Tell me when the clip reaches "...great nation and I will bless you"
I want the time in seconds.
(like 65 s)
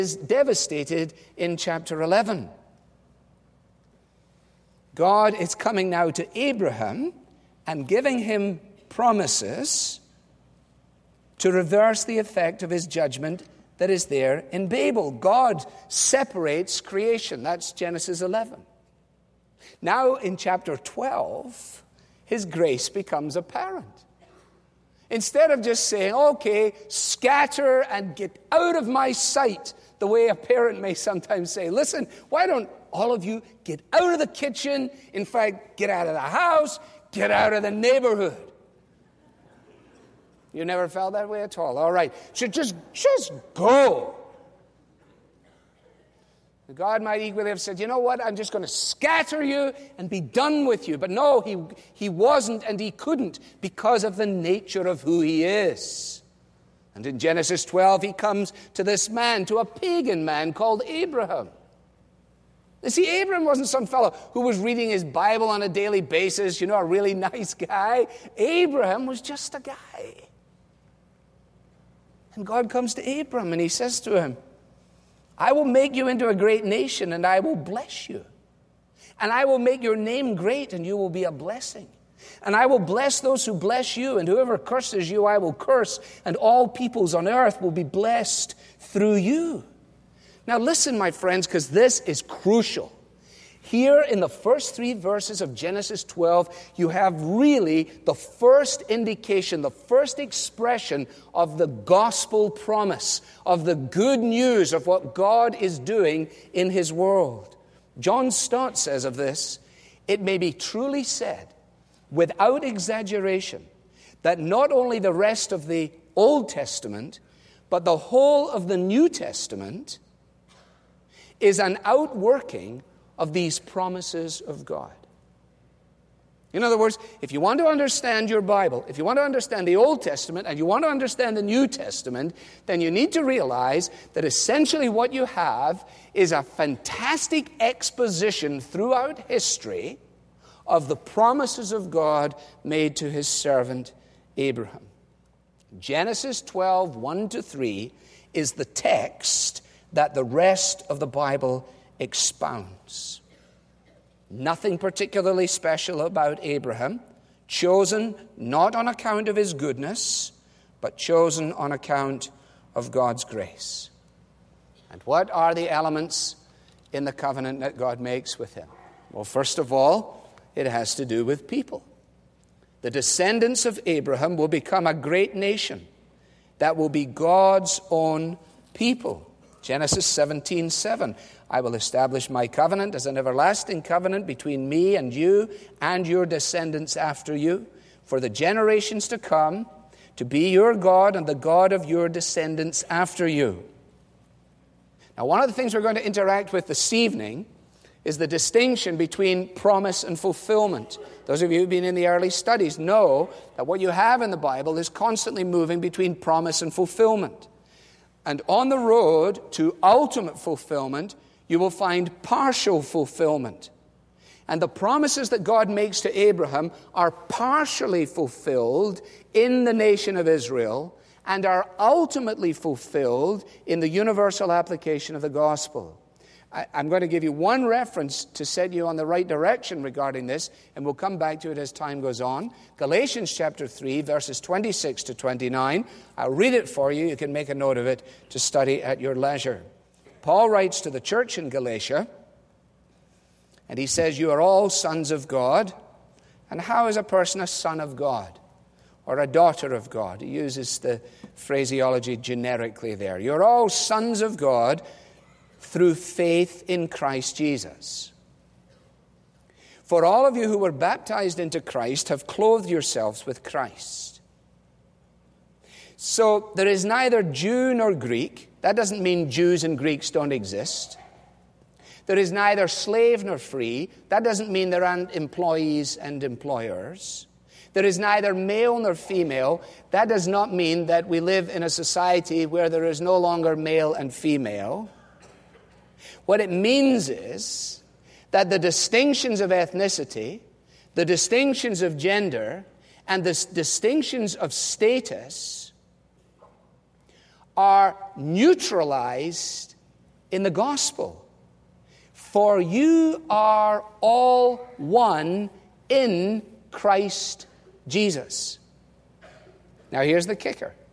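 76 s.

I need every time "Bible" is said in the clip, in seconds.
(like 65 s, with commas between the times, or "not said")
65 s, 128 s, 151 s, 204 s.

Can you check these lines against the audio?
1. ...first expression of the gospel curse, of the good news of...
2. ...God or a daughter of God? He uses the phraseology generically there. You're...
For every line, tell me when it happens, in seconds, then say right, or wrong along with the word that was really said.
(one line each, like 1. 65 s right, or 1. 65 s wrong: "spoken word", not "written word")
1. 99 s wrong: "promise", not "curse"
2. 247 s right.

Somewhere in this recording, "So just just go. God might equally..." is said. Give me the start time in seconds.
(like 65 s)
42 s.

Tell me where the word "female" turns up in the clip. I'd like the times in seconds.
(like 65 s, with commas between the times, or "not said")
278 s, 284 s.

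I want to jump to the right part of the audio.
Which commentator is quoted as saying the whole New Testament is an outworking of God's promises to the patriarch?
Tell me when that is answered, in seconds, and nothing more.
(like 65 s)
107 s.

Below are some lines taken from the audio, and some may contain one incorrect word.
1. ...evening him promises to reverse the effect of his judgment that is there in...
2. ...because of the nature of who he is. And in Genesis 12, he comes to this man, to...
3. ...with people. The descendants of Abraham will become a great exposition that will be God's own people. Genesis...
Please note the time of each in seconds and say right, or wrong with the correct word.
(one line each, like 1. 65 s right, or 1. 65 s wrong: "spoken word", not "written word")
1. 7 s wrong: "giving", not "evening"
2. 53 s right
3. 171 s wrong: "nation", not "exposition".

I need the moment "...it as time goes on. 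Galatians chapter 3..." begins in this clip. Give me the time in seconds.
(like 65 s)
231 s.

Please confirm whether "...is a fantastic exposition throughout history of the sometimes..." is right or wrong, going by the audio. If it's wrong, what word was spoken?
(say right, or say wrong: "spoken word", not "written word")
wrong: "promises", not "sometimes".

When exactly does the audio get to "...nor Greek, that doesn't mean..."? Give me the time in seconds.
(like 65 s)
267 s.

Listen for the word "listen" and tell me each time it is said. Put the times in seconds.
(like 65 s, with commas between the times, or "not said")
31 s, 90 s.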